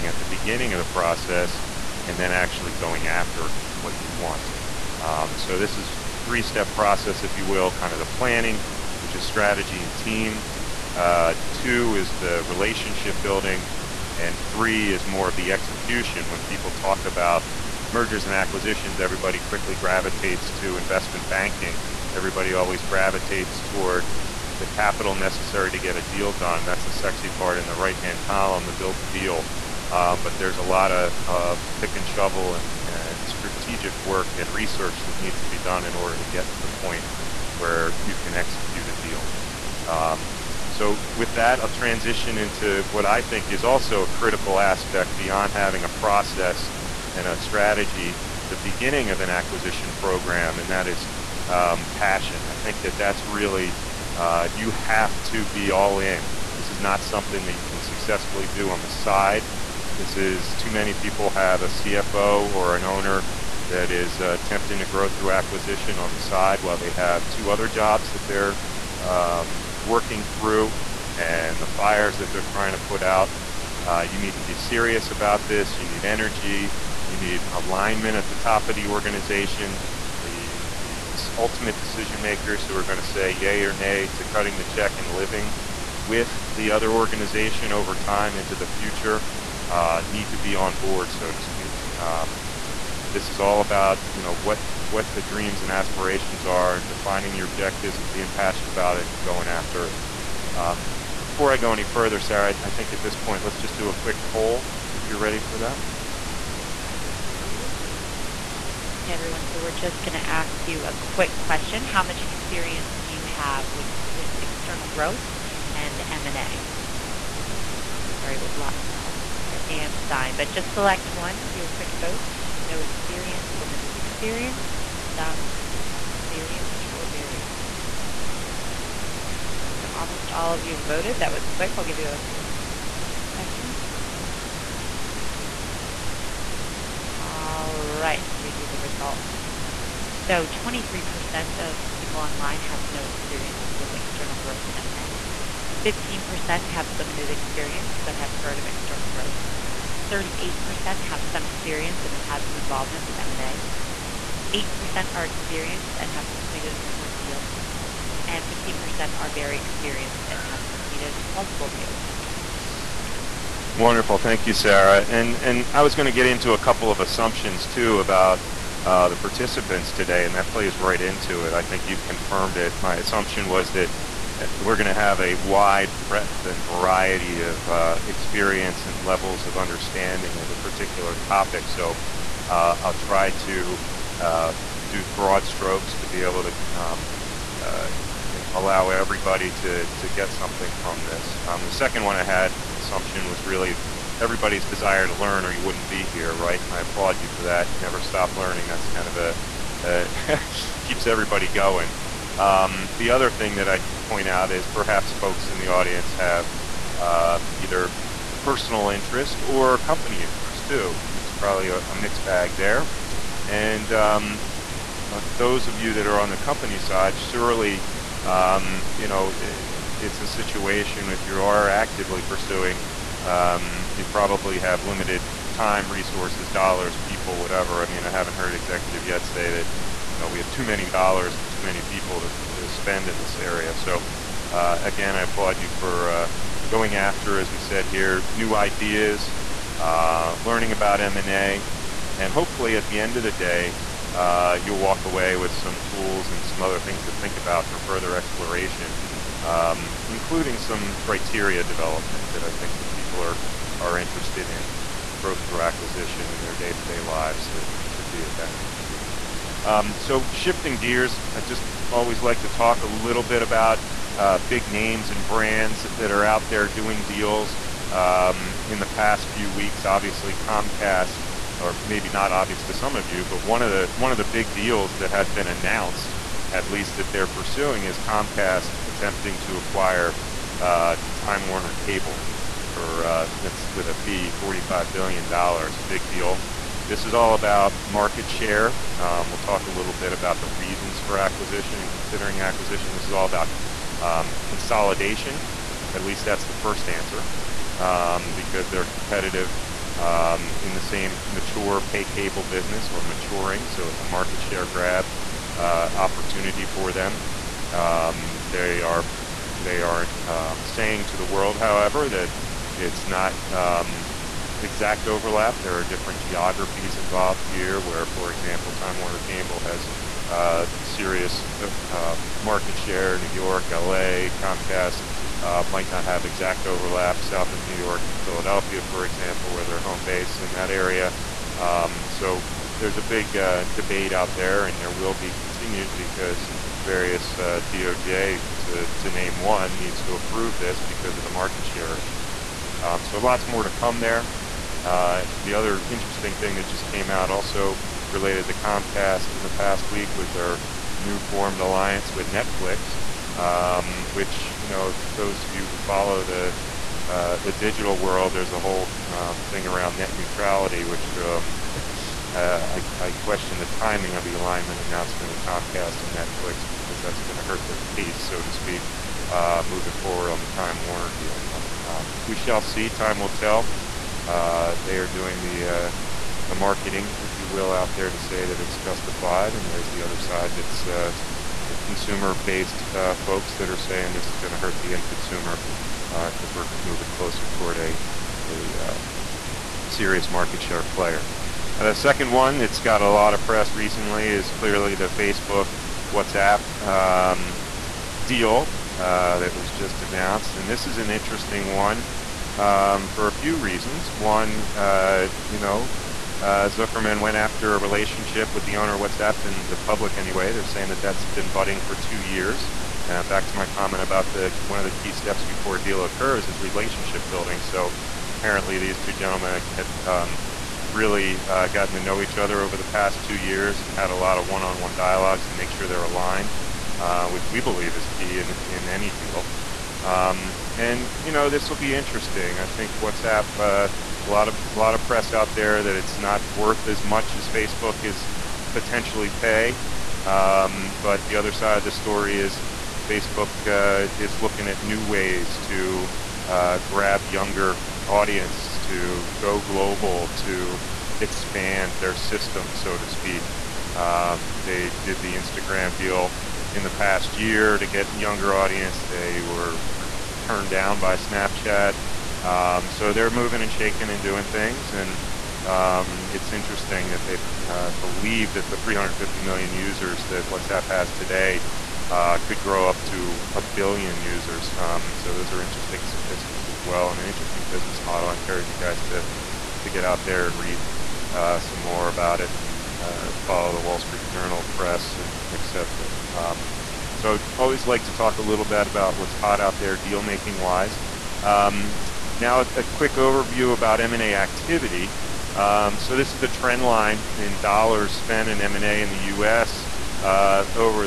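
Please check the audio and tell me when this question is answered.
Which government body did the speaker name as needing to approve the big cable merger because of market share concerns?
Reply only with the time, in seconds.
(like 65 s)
337 s.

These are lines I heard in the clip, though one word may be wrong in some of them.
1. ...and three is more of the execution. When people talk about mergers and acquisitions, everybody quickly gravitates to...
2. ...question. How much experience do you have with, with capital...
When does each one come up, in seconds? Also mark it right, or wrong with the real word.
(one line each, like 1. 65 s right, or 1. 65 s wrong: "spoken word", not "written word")
1. 14 s right
2. 111 s wrong: "external", not "capital".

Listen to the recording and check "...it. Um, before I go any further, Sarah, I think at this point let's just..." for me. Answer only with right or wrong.
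right.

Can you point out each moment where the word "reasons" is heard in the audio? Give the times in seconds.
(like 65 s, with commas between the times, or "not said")
290 s, 403 s.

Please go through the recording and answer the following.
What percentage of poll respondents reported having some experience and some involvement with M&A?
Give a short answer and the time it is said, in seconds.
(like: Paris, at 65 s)
38%, at 150 s.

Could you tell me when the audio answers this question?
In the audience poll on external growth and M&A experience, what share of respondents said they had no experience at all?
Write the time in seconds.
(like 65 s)
140 s.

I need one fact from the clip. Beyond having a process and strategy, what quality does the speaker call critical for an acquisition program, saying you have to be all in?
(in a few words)
Passion.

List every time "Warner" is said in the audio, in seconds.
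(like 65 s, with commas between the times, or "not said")
281 s, 318 s, 370 s.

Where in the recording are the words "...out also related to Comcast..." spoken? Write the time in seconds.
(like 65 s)
347 s.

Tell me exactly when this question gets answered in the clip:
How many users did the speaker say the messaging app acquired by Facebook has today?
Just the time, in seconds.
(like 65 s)
468 s.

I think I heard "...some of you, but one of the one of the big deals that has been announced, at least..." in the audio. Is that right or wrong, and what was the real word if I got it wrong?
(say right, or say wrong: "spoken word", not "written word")
right.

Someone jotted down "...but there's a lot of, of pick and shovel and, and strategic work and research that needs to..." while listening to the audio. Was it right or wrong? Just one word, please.
right.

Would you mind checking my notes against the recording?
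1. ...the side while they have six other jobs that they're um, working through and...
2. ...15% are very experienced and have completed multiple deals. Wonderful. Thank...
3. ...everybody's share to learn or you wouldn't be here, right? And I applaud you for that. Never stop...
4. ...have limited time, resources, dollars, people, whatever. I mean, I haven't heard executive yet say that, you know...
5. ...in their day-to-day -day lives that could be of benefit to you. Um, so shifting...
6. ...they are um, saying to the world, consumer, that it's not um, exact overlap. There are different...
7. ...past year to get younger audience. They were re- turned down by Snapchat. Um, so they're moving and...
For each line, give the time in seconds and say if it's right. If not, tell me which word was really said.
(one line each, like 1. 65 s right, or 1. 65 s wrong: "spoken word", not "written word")
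1. 66 s wrong: "two", not "six"
2. 158 s right
3. 194 s wrong: "desire", not "share"
4. 224 s right
5. 256 s right
6. 309 s wrong: "however", not "consumer"
7. 456 s right.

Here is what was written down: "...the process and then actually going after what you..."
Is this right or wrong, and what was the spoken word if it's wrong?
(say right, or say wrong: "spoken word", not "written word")
right.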